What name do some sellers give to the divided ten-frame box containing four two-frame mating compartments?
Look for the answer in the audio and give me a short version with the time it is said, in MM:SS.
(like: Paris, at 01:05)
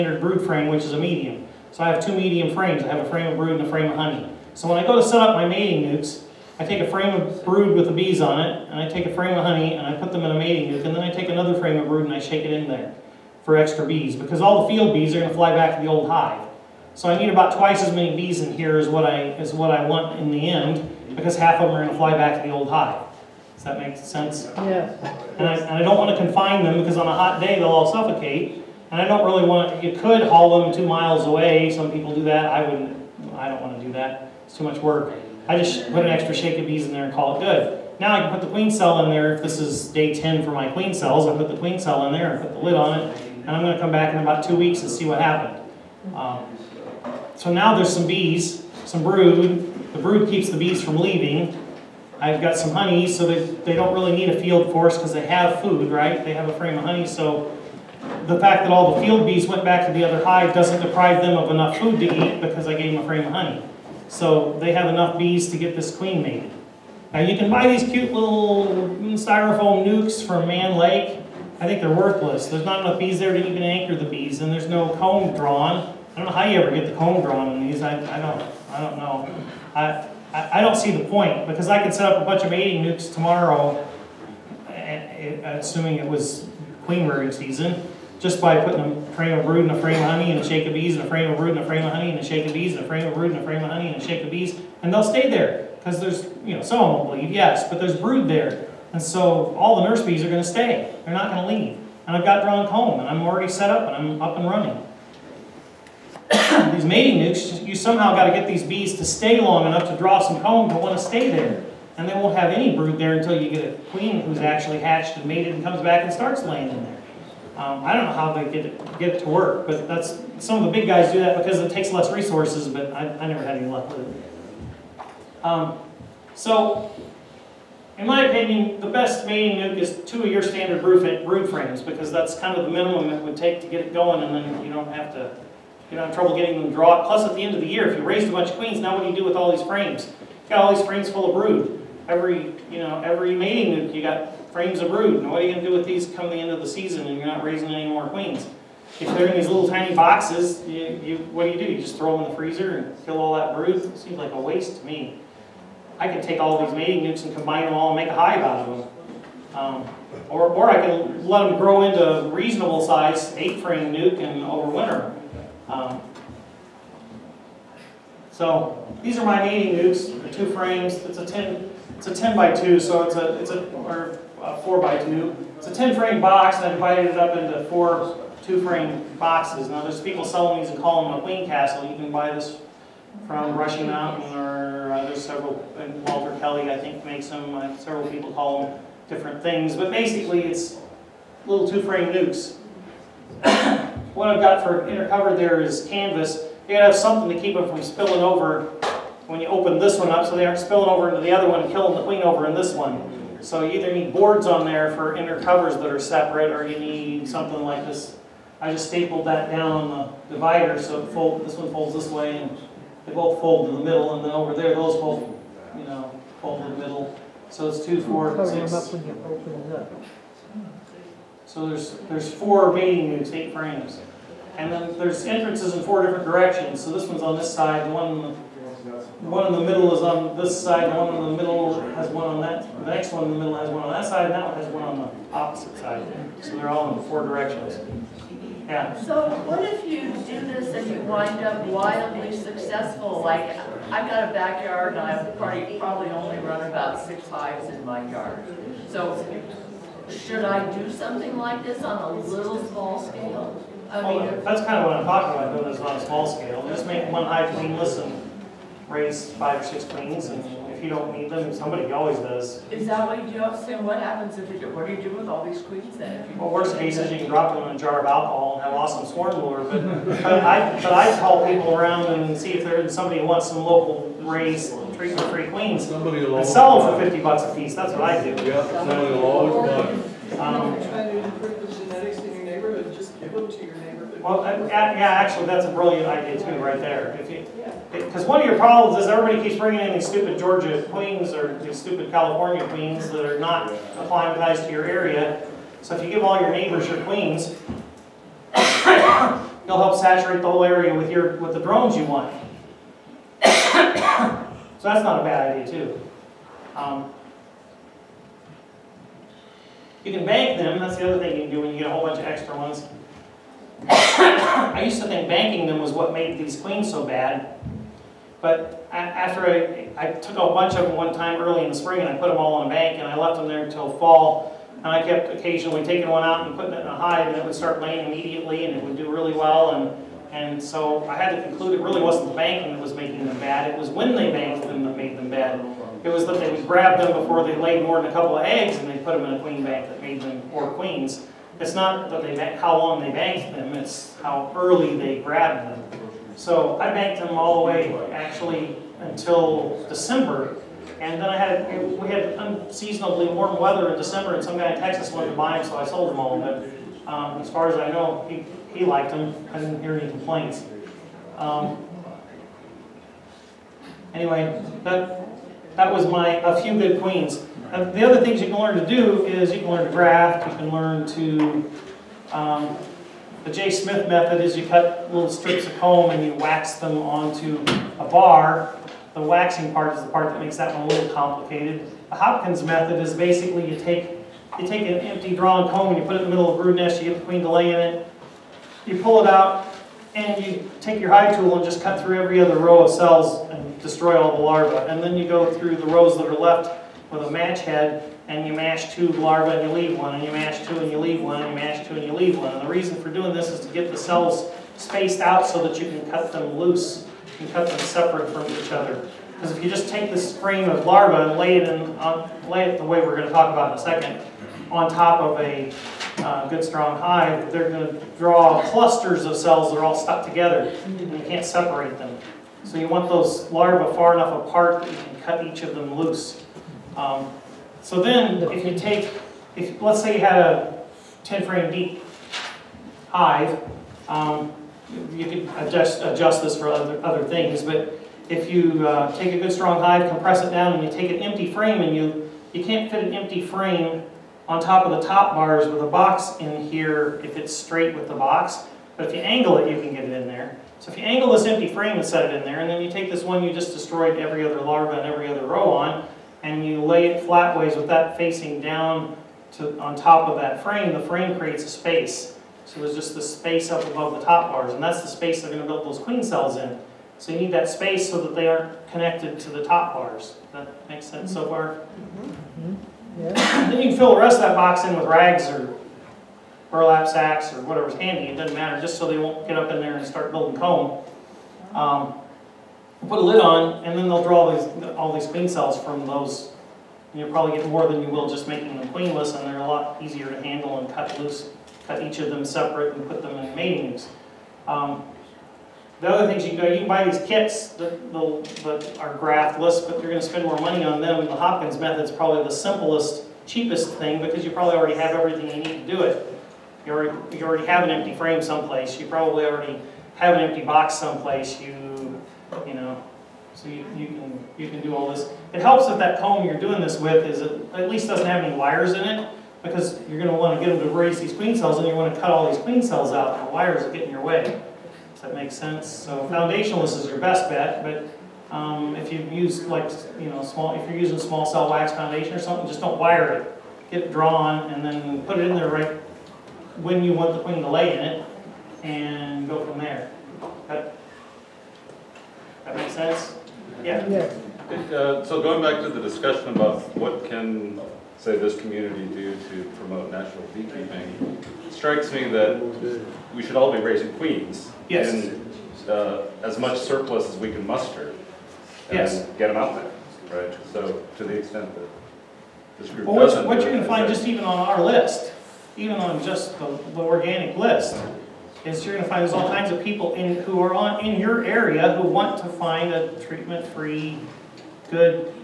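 Queen Castle, at 03:01.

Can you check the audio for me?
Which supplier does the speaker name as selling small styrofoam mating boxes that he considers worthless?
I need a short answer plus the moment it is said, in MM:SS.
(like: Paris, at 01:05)
Mann Lake, at 01:10.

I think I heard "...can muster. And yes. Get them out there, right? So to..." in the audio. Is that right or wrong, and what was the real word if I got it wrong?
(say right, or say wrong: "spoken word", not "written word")
right.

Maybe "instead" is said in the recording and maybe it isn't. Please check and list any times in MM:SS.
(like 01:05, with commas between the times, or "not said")
not said.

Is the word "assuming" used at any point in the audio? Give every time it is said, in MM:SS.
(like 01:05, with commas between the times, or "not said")
01:25.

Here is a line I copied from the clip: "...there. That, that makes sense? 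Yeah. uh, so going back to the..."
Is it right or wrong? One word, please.
right.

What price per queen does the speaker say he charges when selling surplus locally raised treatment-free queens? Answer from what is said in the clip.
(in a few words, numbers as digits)
$50.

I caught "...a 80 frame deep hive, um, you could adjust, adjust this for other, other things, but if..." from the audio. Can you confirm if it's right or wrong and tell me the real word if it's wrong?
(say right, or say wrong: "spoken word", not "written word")
wrong: "10", not "80".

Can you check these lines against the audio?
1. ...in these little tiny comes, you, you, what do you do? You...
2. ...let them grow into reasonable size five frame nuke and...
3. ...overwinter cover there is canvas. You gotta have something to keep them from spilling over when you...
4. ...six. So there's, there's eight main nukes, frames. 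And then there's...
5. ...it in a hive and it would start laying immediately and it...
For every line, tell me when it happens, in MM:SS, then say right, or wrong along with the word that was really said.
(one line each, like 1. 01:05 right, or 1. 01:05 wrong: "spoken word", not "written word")
1. 02:29 wrong: "boxes", not "comes"
2. 02:41 wrong: "eight", not "five"
3. 03:14 wrong: "inner", not "overwinter"
4. 03:38 wrong: "four", not "eight"
5. 05:26 right.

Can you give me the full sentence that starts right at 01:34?
And they'll stay there because there's, you know, some of them will leave, yes, but there's brood there.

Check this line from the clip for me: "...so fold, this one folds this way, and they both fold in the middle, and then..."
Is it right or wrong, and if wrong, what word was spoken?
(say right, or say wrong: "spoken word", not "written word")
right.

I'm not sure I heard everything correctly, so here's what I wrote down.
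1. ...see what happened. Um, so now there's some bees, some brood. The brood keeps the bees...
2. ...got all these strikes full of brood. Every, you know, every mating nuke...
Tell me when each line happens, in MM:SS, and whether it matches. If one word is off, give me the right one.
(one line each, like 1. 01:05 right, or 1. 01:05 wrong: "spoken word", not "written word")
1. 00:44 right
2. 02:20 wrong: "frames", not "strikes".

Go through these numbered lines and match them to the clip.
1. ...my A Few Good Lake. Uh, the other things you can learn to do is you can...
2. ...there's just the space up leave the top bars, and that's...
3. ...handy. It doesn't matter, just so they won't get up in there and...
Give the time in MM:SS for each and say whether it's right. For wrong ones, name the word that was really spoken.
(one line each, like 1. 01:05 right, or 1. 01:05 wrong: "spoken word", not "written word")
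1. 06:06 wrong: "Queens", not "Lake"
2. 07:42 wrong: "above", not "leave"
3. 07:58 right.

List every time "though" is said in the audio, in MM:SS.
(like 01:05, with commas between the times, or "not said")
04:15.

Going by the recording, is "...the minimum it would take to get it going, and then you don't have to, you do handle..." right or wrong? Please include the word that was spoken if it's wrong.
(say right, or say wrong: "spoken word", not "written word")
wrong: "trouble", not "handle".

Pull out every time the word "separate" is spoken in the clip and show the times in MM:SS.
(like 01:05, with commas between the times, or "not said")
03:25, 06:47, 07:01, 08:12.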